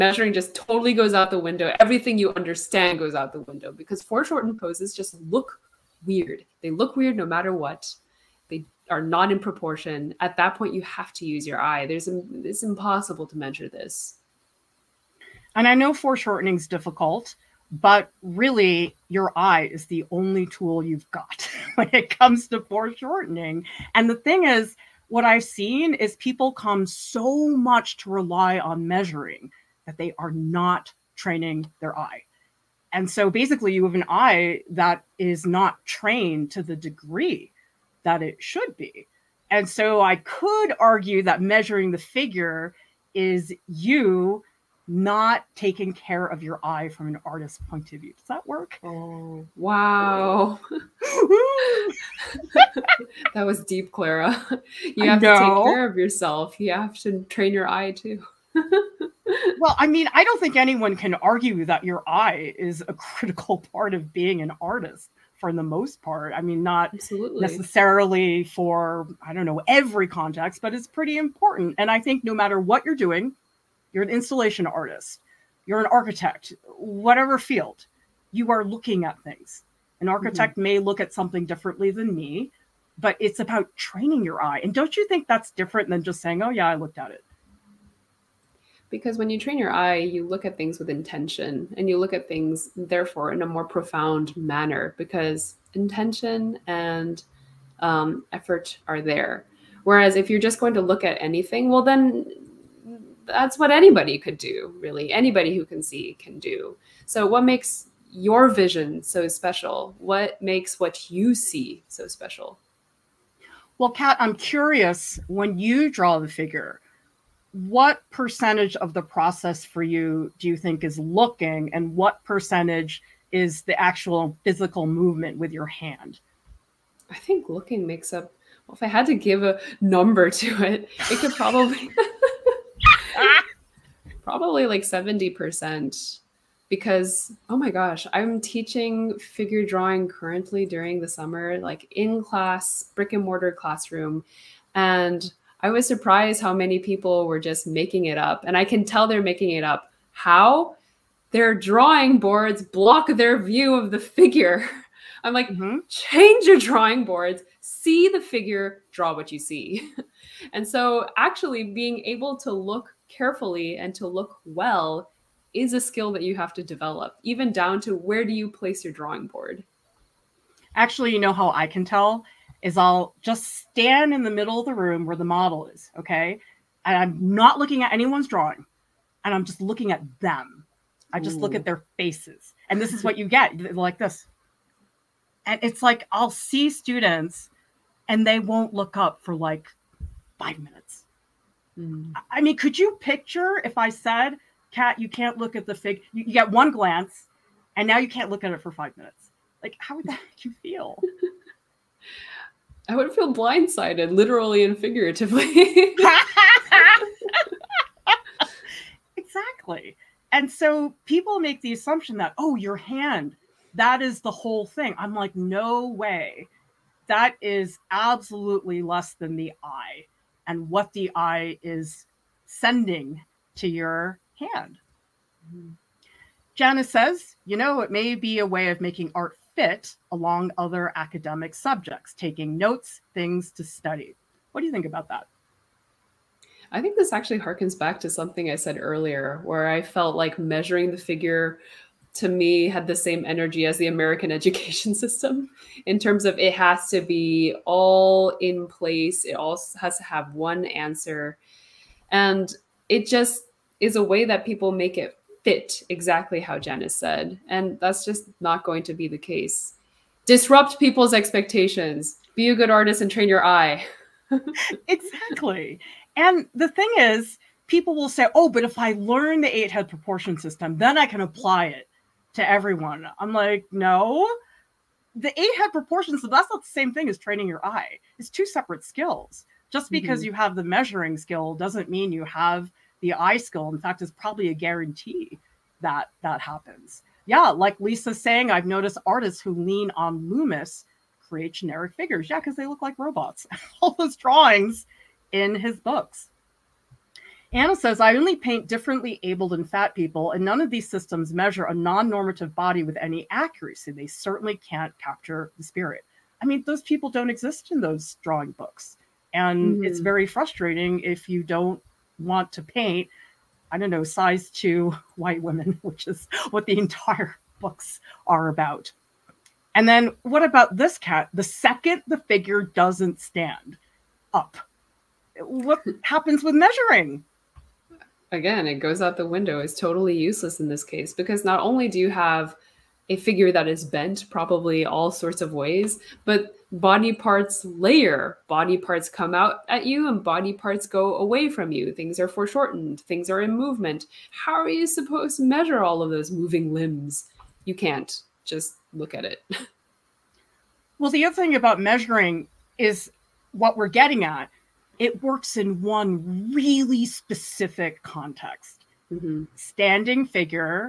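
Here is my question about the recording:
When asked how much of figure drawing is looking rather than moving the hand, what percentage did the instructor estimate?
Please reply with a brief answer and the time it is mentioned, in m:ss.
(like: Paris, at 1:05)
70%, at 2:14.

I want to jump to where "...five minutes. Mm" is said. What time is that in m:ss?
3:10.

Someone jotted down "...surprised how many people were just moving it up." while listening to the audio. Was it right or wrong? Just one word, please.
wrong.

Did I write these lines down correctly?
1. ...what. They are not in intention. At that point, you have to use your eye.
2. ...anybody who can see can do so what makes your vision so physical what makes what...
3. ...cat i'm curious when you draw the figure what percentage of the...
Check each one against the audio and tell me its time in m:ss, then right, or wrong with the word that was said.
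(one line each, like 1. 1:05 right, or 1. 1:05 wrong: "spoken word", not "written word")
1. 0:07 wrong: "proportion", not "intention"
2. 1:45 wrong: "special", not "physical"
3. 1:53 right.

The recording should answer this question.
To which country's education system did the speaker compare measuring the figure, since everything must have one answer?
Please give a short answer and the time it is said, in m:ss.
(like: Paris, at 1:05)
American, at 4:03.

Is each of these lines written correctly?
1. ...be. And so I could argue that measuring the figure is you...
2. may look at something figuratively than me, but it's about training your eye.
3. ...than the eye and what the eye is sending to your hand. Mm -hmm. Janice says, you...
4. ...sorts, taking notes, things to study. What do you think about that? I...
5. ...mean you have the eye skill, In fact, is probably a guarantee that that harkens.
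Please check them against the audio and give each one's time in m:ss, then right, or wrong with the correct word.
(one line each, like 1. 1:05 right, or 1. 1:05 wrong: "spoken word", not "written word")
1. 0:38 right
2. 1:20 wrong: "differently", not "figuratively"
3. 3:39 right
4. 3:51 wrong: "subjects", not "sorts"
5. 4:41 wrong: "happens", not "harkens".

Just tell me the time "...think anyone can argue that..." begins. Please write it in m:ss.
1:00.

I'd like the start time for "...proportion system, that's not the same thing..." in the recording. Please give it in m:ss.
4:35.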